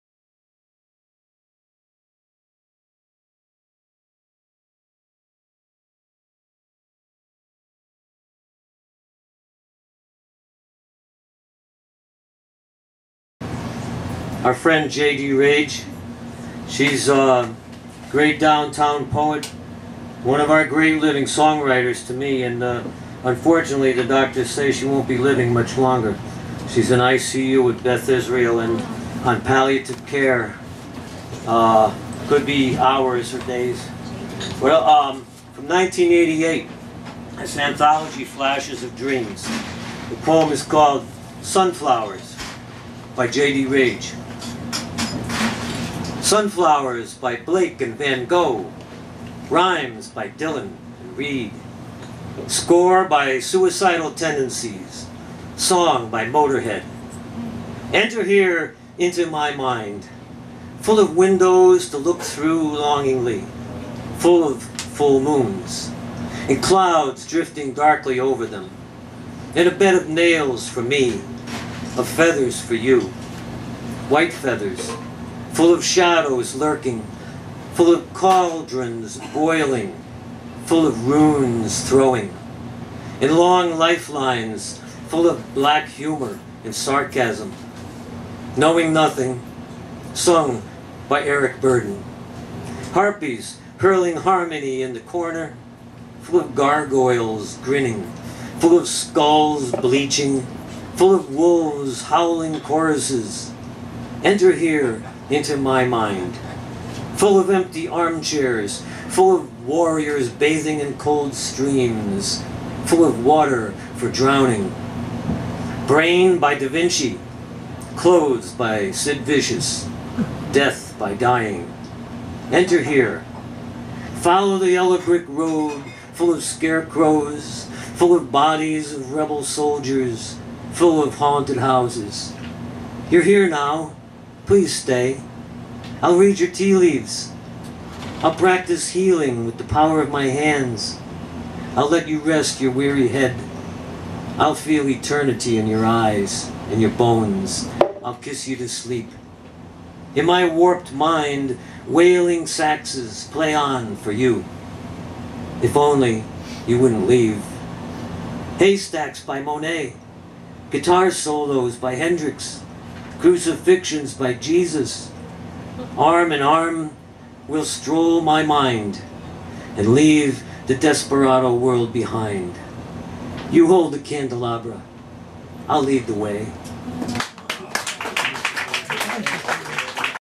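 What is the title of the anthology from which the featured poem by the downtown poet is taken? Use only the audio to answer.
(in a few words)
Flashes of Dreams.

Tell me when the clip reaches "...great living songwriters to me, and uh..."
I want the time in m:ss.
0:20.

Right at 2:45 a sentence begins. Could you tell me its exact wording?
Arm in arm will stroll my mind and leave the desperado world behind.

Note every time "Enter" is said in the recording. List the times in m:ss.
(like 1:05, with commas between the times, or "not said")
0:57, 1:44, 2:02.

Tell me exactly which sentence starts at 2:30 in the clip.
In my warped mind, wailing saxes play on for you.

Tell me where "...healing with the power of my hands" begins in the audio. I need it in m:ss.
2:18.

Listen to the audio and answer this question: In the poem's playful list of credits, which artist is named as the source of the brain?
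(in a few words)
Da Vinci.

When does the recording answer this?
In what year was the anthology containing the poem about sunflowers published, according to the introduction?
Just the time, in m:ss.
0:35.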